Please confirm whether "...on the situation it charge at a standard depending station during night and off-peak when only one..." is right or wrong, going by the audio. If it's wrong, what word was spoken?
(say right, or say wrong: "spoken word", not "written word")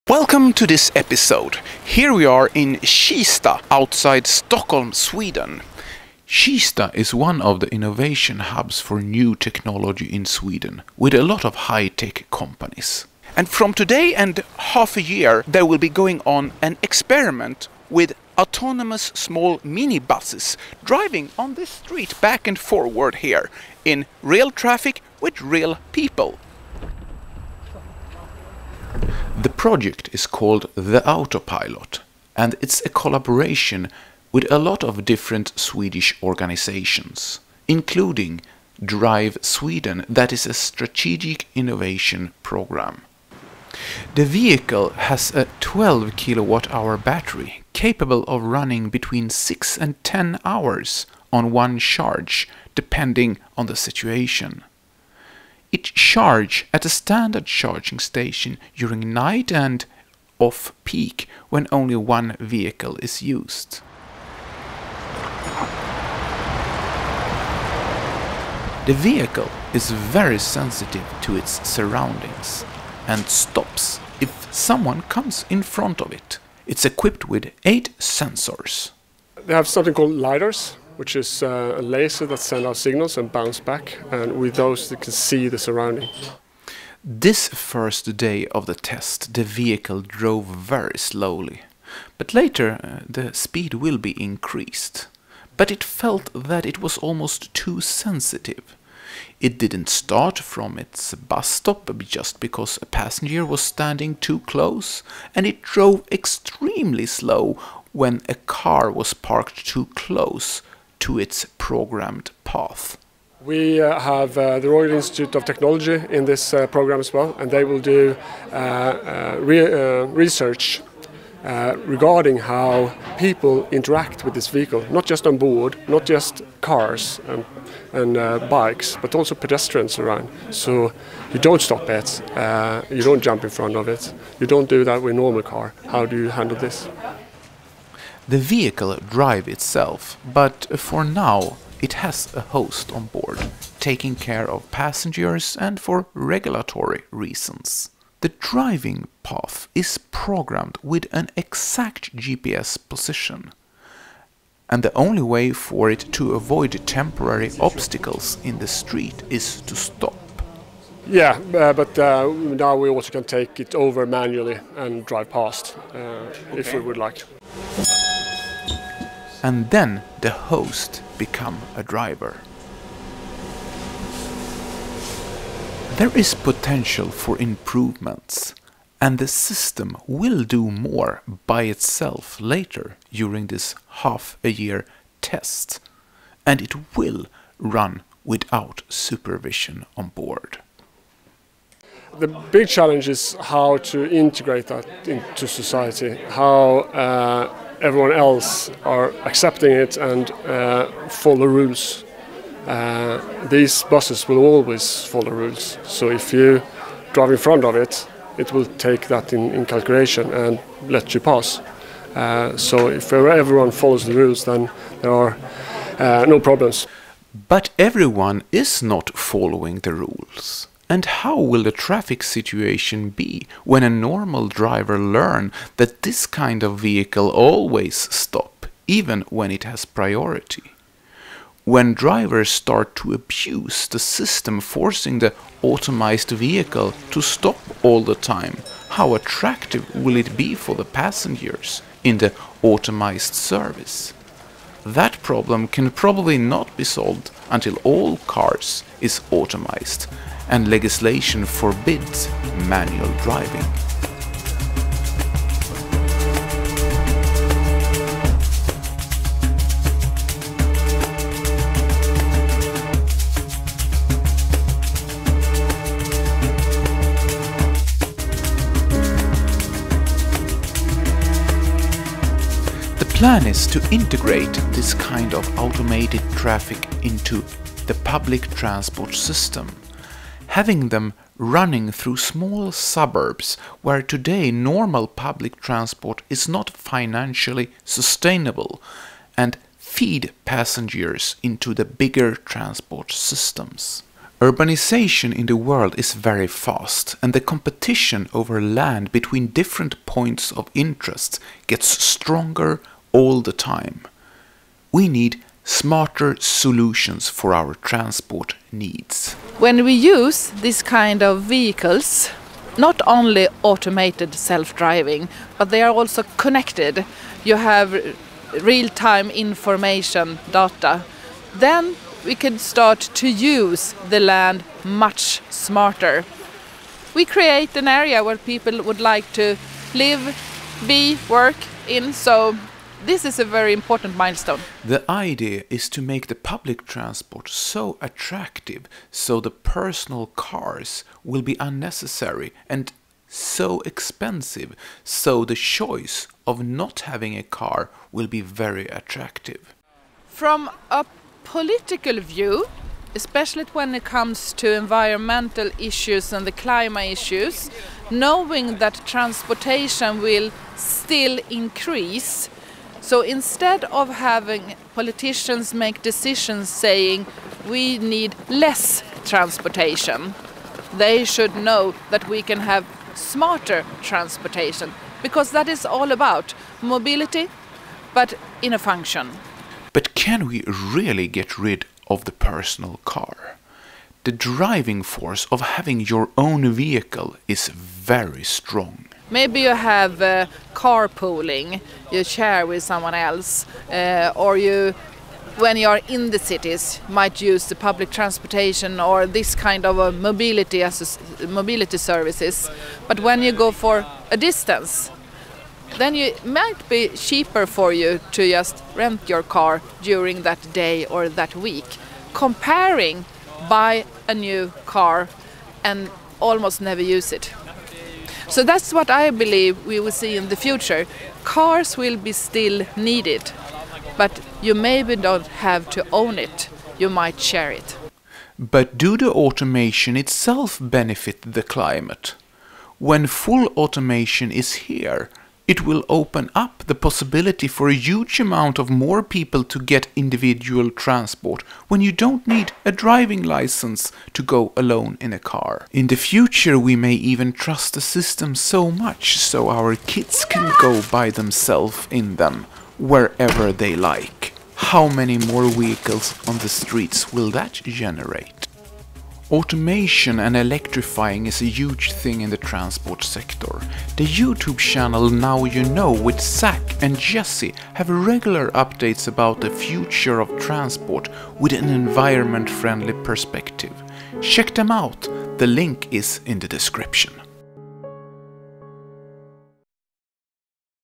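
wrong: "charging", not "depending".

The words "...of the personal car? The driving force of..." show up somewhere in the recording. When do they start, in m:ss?
6:22.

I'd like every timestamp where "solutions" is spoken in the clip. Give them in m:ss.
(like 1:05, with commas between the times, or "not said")
5:06.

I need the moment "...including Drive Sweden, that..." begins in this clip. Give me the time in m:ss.
0:37.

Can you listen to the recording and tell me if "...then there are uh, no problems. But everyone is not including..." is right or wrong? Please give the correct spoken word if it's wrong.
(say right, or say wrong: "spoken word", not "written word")
wrong: "following", not "including".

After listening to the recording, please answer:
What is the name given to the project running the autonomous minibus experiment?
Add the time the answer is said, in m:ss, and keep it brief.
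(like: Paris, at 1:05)
The Autopilot, at 0:30.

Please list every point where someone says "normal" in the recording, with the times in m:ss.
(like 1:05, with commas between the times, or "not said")
2:15, 3:43, 4:44.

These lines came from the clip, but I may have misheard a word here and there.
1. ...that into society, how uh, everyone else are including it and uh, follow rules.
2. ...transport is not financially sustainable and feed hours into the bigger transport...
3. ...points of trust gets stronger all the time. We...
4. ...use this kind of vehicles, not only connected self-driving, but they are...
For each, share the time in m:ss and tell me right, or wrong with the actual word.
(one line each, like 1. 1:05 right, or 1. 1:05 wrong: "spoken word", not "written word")
1. 3:14 wrong: "accepting", not "including"
2. 4:45 wrong: "passengers", not "hours"
3. 5:00 wrong: "interest", not "trust"
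4. 5:09 wrong: "automated", not "connected".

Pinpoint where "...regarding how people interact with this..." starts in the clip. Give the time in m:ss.
2:01.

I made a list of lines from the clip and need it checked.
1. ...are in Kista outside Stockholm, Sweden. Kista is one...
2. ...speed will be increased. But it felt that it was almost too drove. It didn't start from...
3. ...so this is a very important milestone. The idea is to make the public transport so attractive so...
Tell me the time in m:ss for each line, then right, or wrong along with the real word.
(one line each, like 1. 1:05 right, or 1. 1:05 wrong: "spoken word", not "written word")
1. 0:02 right
2. 1:33 wrong: "sensitive", not "drove"
3. 5:32 right.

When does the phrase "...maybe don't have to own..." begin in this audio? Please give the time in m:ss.
7:04.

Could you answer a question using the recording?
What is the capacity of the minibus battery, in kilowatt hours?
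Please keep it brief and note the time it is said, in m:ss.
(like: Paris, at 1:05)
12, at 0:45.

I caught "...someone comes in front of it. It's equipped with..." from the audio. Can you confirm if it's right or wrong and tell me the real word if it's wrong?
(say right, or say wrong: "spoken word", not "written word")
right.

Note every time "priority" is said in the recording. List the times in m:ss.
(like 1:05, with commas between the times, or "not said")
3:49.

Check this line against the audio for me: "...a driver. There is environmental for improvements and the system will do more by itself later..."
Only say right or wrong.
wrong.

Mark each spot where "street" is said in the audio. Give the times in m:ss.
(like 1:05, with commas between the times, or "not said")
0:21, 2:38, 7:36.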